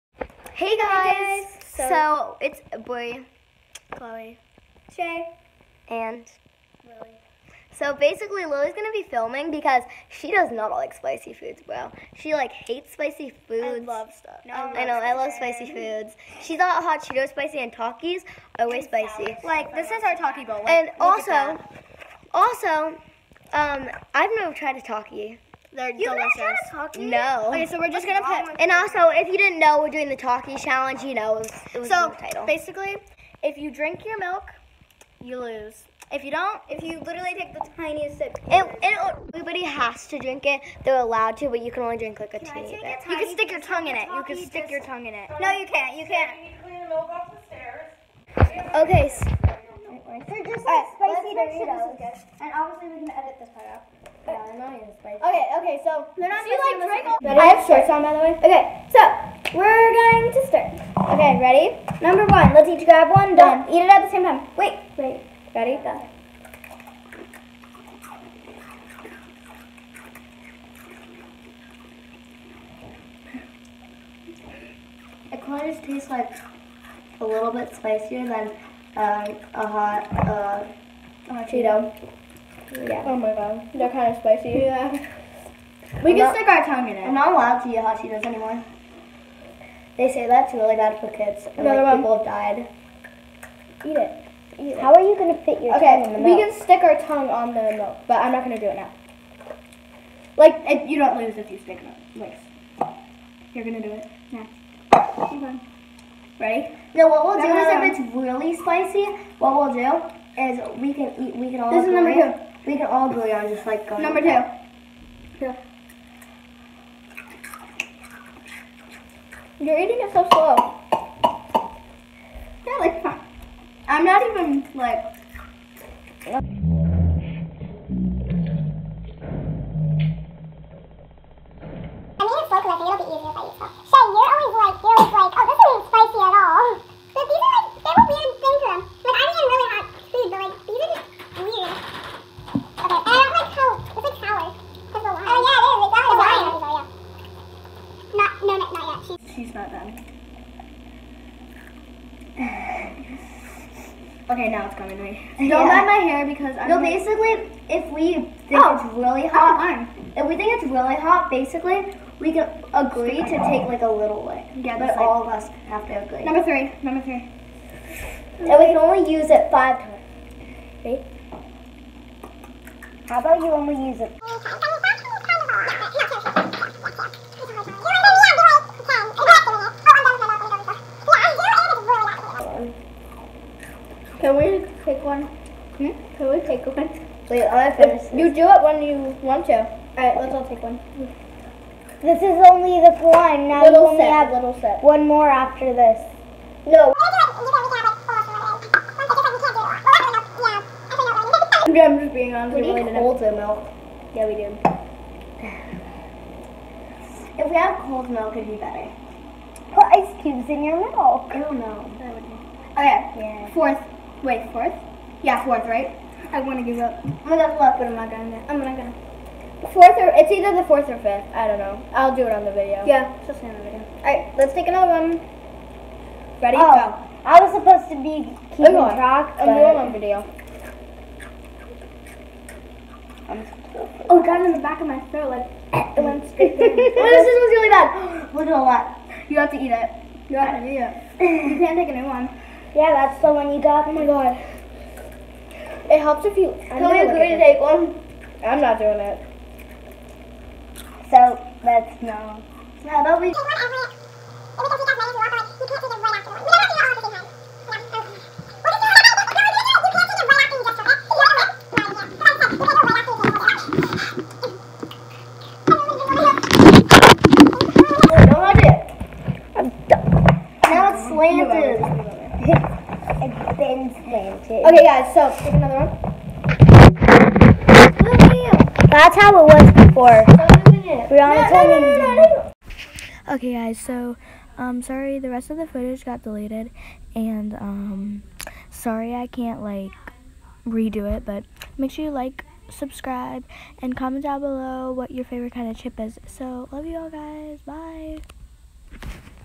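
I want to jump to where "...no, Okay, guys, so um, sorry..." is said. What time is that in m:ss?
4:42.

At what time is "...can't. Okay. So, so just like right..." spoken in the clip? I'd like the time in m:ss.
0:46.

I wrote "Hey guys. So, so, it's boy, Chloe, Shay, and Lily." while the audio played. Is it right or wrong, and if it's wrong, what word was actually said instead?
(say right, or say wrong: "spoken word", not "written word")
right.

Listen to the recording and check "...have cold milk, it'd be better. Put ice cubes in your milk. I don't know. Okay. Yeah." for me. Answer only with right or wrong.
right.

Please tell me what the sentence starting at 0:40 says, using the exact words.
They're allowed to, but you can only drink like a can teeny bit.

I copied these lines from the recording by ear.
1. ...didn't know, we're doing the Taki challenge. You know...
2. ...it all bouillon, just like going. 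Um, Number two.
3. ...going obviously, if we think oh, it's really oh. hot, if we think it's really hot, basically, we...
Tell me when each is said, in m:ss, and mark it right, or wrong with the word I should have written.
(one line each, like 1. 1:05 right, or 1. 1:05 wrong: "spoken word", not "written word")
1. 0:29 right
2. 1:52 right
3. 2:36 wrong: "basically", not "obviously".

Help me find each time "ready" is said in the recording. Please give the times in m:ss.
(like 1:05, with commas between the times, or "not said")
0:57, 1:01, 1:05, 1:46, 3:46.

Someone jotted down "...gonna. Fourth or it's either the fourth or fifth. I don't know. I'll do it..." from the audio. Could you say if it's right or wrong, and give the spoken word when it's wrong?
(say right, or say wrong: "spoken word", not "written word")
right.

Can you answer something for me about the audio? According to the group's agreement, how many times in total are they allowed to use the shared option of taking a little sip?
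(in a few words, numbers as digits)
5.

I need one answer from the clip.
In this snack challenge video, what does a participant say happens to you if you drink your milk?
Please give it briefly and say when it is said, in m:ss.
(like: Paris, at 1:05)
You lose, at 0:35.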